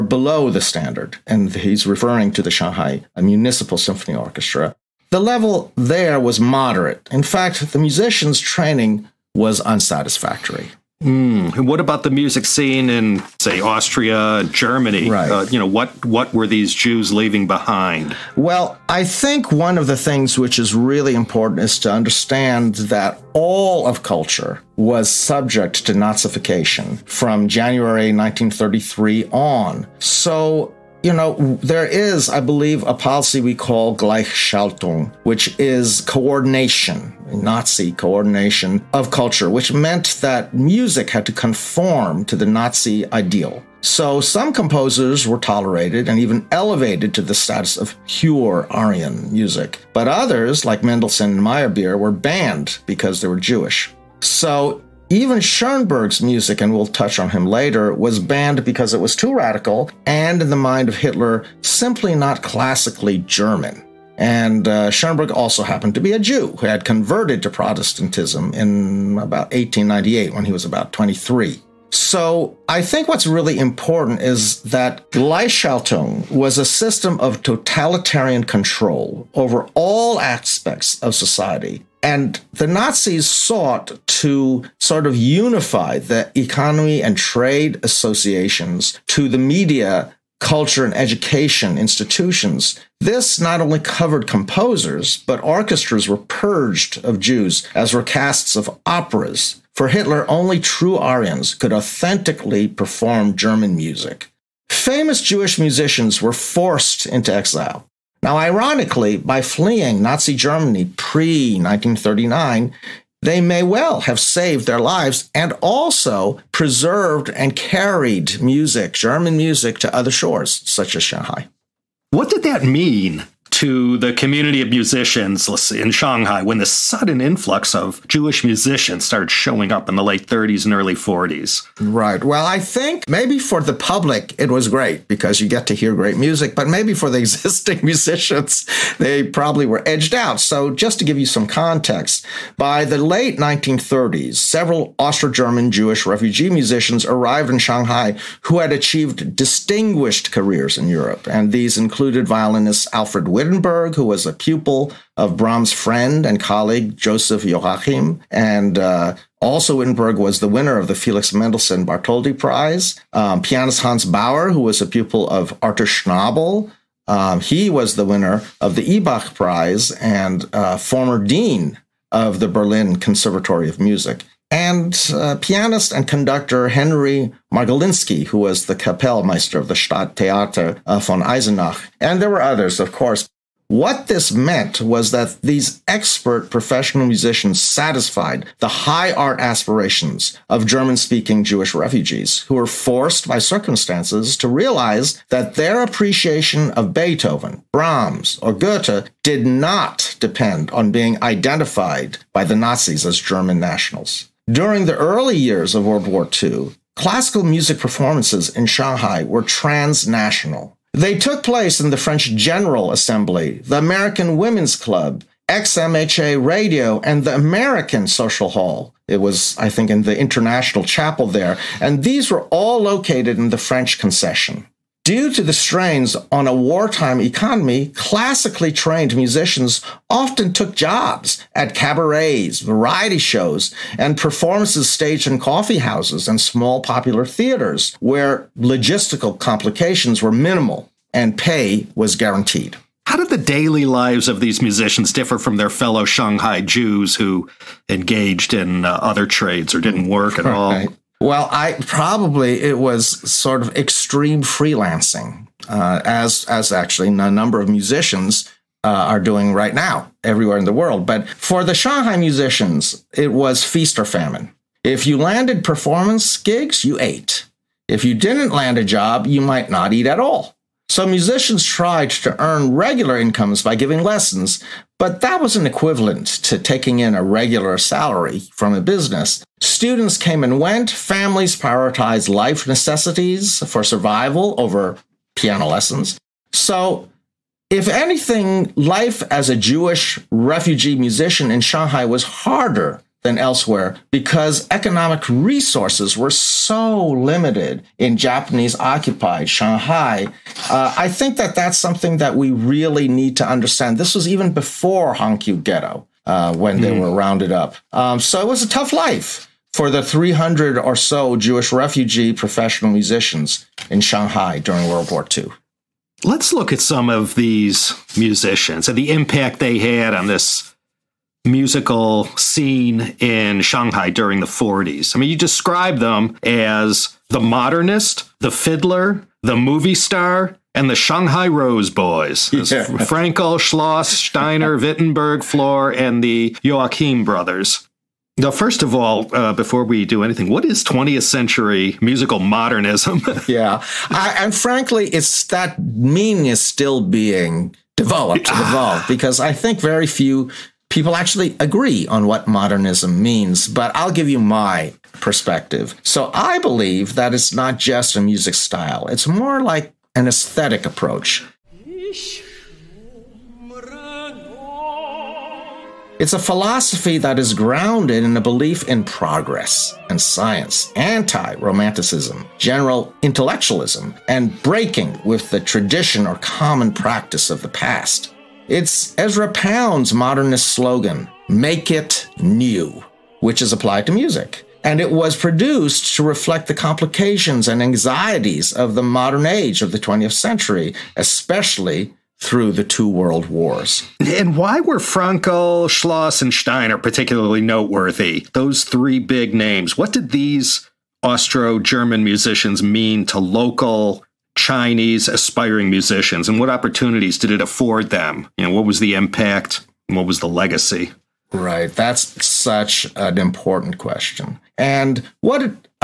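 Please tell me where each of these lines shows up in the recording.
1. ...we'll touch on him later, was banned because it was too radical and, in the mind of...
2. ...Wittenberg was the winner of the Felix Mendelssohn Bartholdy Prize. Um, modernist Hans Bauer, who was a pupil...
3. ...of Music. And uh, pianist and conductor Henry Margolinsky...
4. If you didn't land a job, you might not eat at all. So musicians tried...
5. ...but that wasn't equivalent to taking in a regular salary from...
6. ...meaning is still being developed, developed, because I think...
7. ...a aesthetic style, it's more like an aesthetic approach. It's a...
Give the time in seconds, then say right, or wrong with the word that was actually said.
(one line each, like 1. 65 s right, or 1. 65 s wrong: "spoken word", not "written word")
1. 56 s right
2. 159 s wrong: "pianist", not "modernist"
3. 173 s right
4. 267 s right
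5. 274 s right
6. 345 s right
7. 358 s wrong: "music", not "aesthetic".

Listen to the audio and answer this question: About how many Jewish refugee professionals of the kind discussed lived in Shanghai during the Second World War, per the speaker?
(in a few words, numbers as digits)
300.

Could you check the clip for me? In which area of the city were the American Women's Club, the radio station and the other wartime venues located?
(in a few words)
the French concession.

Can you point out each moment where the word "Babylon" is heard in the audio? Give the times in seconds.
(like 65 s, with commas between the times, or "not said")
not said.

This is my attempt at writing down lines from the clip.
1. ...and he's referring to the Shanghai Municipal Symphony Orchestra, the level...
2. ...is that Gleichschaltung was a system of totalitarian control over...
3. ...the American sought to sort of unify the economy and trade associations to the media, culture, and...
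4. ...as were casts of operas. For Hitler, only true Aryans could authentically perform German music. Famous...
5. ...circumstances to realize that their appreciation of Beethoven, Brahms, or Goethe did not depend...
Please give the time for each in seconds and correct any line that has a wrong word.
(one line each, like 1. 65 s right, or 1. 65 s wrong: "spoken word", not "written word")
1. 1 s right
2. 74 s right
3. 82 s wrong: "Nazis", not "American"
4. 97 s right
5. 193 s right.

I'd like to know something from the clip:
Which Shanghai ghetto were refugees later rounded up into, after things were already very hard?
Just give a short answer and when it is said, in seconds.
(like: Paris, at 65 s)
Hongkew Ghetto, at 305 s.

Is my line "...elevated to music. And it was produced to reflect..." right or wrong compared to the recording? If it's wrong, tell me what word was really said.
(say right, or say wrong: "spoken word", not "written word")
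wrong: "applied", not "elevated".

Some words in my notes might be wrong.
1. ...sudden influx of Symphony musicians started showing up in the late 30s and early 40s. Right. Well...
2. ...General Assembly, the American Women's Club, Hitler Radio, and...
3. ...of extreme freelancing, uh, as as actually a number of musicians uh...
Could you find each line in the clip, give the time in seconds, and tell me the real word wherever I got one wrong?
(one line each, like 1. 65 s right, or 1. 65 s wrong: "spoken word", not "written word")
1. 126 s wrong: "Jewish", not "Symphony"
2. 212 s wrong: "XMHA", not "Hitler"
3. 253 s right.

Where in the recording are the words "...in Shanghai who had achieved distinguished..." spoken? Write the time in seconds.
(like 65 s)
147 s.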